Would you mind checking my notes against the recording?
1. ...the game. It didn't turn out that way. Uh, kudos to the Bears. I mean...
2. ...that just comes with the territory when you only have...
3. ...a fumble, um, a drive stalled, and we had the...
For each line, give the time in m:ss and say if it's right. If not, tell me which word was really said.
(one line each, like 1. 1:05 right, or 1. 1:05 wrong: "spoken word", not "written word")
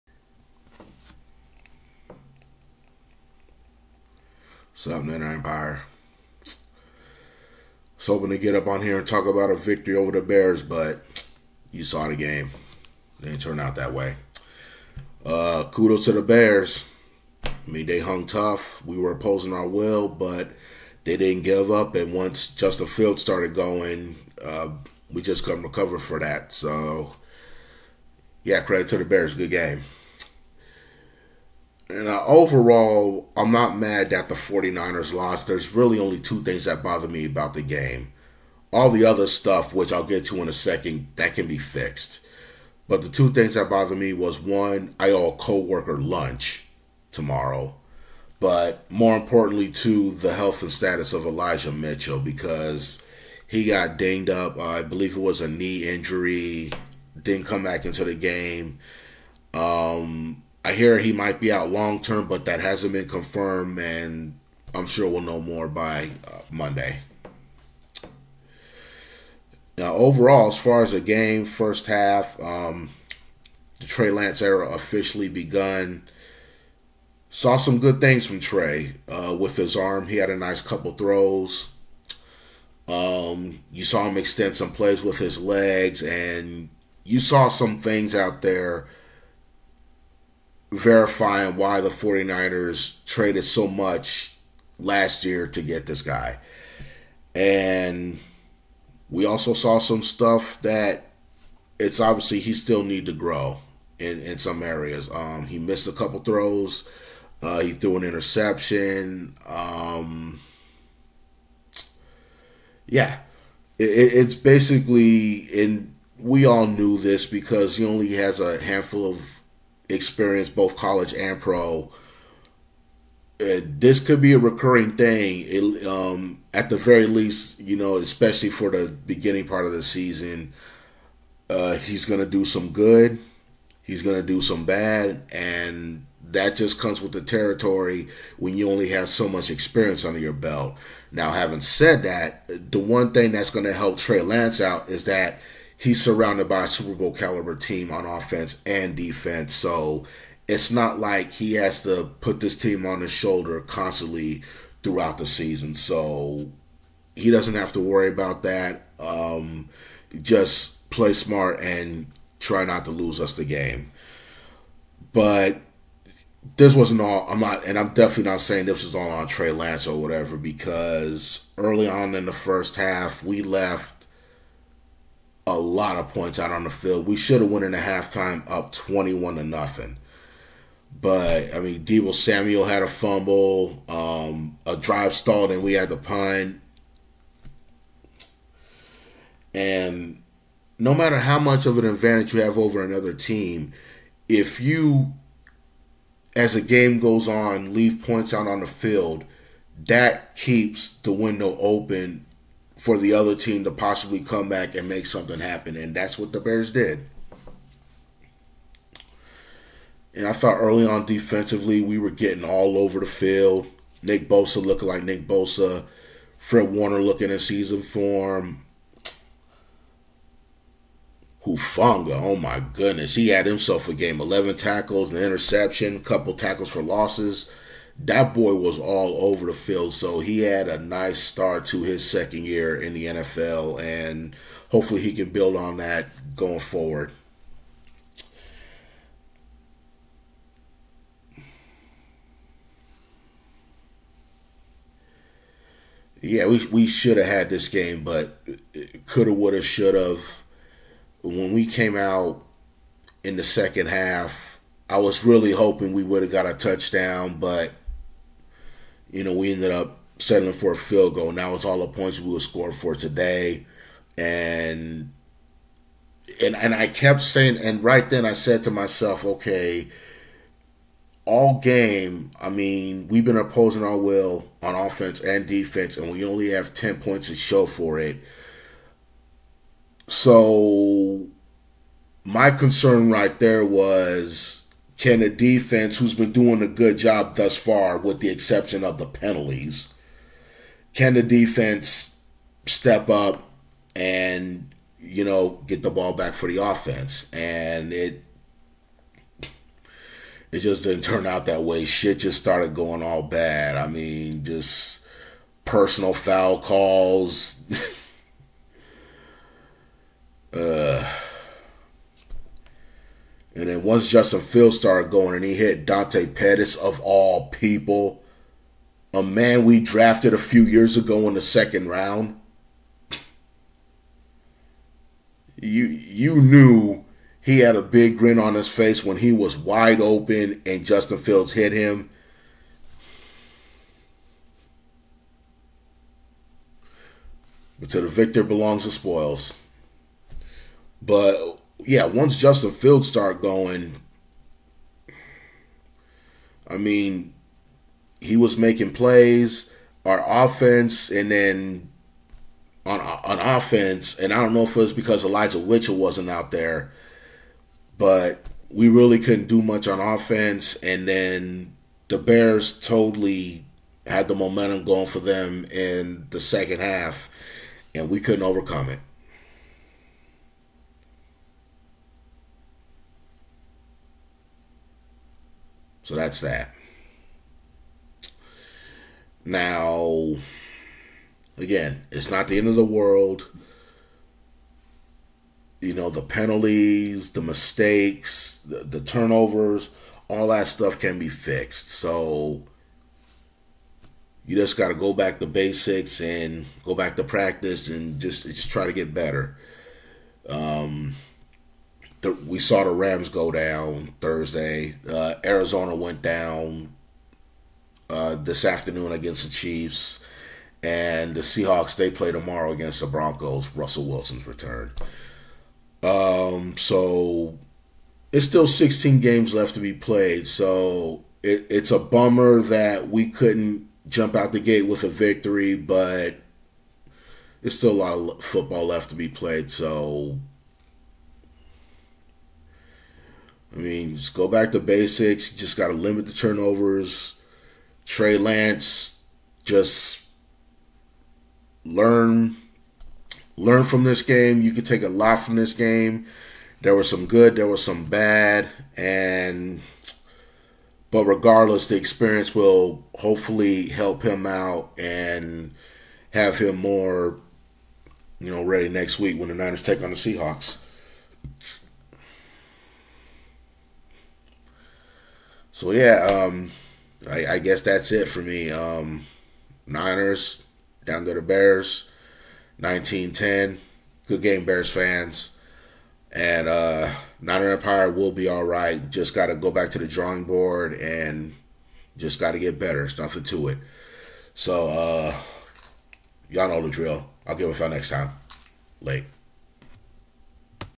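1. 0:12 right
2. 2:16 right
3. 3:02 right.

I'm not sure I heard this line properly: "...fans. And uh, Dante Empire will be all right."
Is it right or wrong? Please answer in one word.
wrong.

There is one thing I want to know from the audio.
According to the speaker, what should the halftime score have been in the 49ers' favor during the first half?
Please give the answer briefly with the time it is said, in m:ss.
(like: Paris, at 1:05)
21-0, at 2:58.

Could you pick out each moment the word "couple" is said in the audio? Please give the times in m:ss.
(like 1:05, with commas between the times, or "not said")
1:20, 1:45, 3:45.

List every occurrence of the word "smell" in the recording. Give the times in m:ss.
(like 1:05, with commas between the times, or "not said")
not said.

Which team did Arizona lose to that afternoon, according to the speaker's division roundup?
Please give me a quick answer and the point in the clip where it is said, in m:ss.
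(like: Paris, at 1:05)
Chiefs, at 6:49.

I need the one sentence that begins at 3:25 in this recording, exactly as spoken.
And that's what the Bears did.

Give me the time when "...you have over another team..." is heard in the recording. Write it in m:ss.
3:12.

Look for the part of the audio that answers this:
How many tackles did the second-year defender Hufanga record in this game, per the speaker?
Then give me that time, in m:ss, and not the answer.
3:44.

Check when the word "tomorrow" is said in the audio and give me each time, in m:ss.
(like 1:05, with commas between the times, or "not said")
0:47, 6:52.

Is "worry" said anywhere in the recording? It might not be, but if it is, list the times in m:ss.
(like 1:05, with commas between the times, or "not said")
2:37.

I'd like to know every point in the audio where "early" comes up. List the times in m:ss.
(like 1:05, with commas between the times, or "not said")
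2:51, 3:30.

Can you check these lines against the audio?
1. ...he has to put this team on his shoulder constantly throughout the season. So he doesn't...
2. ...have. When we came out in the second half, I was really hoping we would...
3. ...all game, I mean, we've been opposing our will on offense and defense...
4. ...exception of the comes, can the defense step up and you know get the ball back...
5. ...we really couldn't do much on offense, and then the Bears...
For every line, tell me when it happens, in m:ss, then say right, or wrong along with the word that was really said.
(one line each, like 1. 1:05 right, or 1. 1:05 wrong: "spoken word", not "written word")
1. 2:31 right
2. 4:09 right
3. 4:31 right
4. 4:48 wrong: "penalties", not "comes"
5. 5:58 right.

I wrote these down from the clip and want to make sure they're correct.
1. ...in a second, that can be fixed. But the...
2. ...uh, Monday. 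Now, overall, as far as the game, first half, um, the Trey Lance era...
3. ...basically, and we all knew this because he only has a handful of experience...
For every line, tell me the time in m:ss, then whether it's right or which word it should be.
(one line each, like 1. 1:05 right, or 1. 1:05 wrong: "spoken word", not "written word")
1. 0:40 right
2. 1:06 right
3. 1:54 right.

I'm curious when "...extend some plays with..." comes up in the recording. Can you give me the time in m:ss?
1:24.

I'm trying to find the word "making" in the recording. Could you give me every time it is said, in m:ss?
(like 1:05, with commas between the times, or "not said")
5:48.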